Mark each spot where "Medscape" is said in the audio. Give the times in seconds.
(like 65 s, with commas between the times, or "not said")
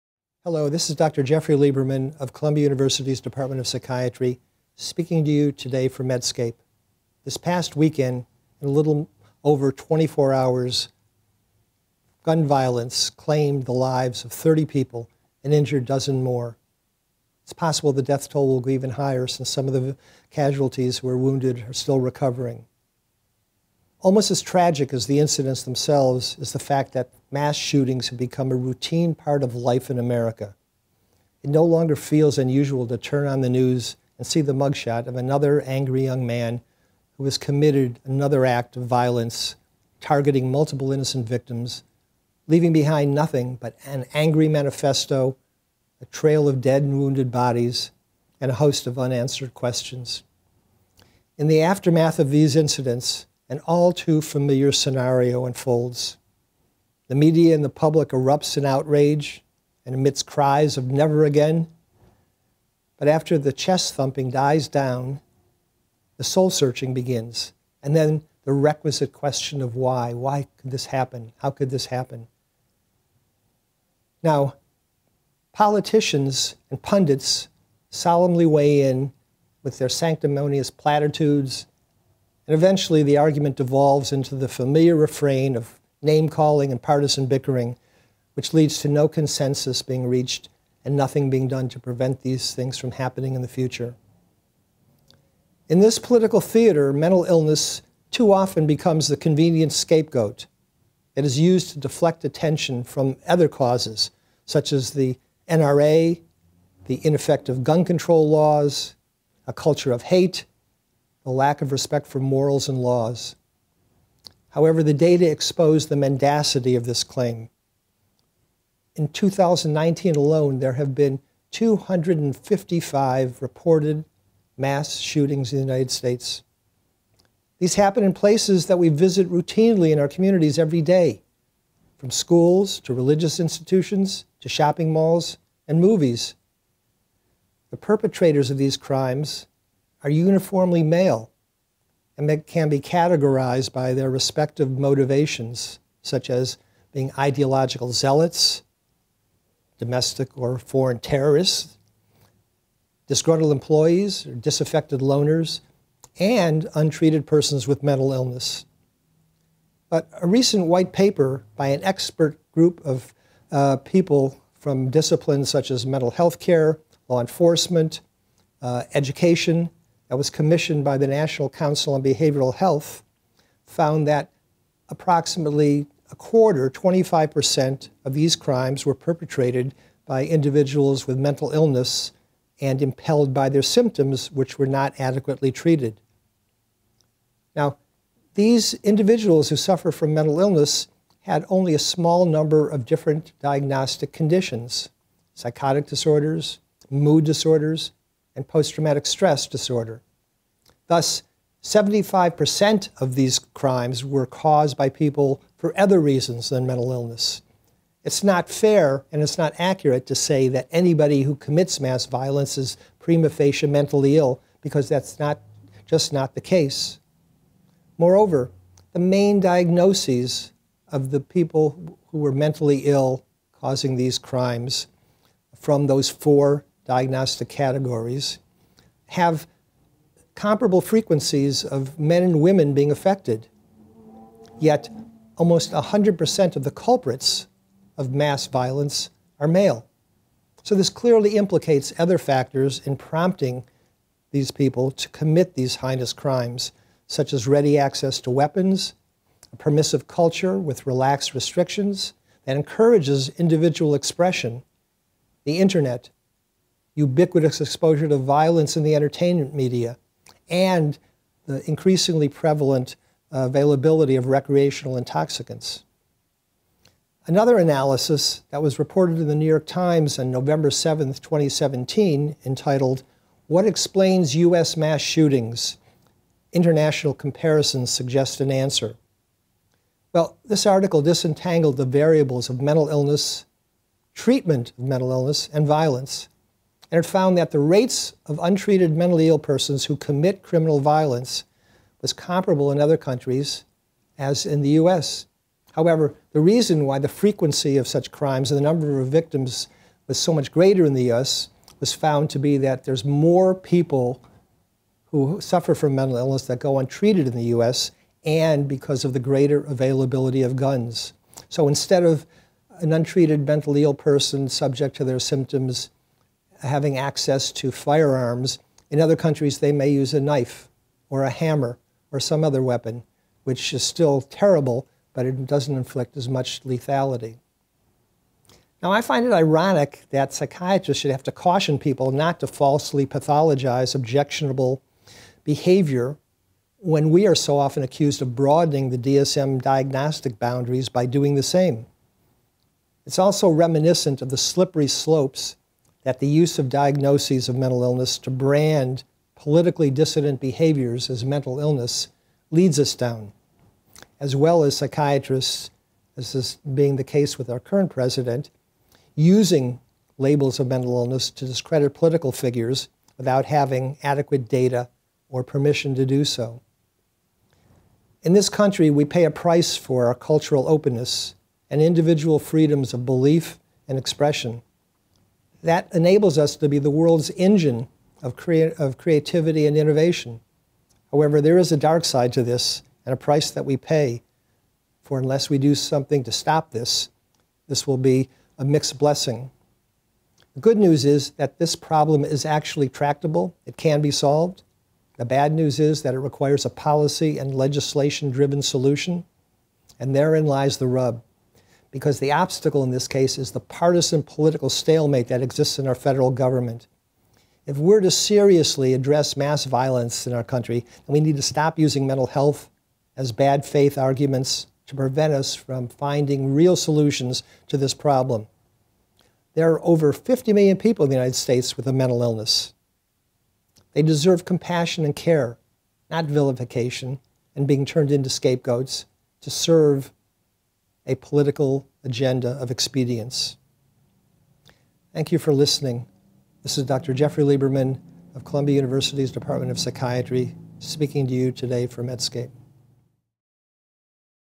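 6 s, 442 s.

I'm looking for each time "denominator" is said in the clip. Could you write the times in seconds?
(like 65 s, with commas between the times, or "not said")
not said.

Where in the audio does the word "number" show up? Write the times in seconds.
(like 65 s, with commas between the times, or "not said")
192 s, 298 s.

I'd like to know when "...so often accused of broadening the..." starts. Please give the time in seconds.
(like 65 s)
337 s.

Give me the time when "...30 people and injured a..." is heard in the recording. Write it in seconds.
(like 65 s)
14 s.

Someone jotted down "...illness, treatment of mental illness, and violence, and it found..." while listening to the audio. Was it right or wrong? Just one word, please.
right.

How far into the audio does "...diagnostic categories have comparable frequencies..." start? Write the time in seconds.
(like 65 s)
226 s.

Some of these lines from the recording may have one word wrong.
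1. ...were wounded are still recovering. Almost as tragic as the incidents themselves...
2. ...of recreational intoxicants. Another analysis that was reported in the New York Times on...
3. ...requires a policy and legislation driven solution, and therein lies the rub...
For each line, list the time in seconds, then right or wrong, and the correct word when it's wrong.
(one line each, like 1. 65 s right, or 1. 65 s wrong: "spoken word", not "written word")
1. 21 s right
2. 264 s right
3. 396 s right.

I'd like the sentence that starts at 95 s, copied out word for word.
In this political theater, mental illness too often becomes the convenient scapegoat.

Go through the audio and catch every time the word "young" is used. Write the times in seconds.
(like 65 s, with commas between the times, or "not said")
36 s.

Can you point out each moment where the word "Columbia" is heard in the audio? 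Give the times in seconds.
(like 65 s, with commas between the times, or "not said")
2 s, 438 s.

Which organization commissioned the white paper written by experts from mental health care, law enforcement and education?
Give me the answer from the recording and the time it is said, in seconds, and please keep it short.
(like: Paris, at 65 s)
National Council on Behavioral Health, at 171 s.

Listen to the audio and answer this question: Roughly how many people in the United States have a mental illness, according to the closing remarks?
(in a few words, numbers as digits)
Over 50 million.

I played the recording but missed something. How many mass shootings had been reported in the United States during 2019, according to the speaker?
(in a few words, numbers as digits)
255.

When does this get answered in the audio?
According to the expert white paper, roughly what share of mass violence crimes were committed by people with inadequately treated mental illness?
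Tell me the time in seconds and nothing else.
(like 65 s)
176 s.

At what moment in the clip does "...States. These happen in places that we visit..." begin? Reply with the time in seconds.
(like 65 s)
125 s.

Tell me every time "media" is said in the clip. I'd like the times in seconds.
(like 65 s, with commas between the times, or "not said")
57 s, 259 s.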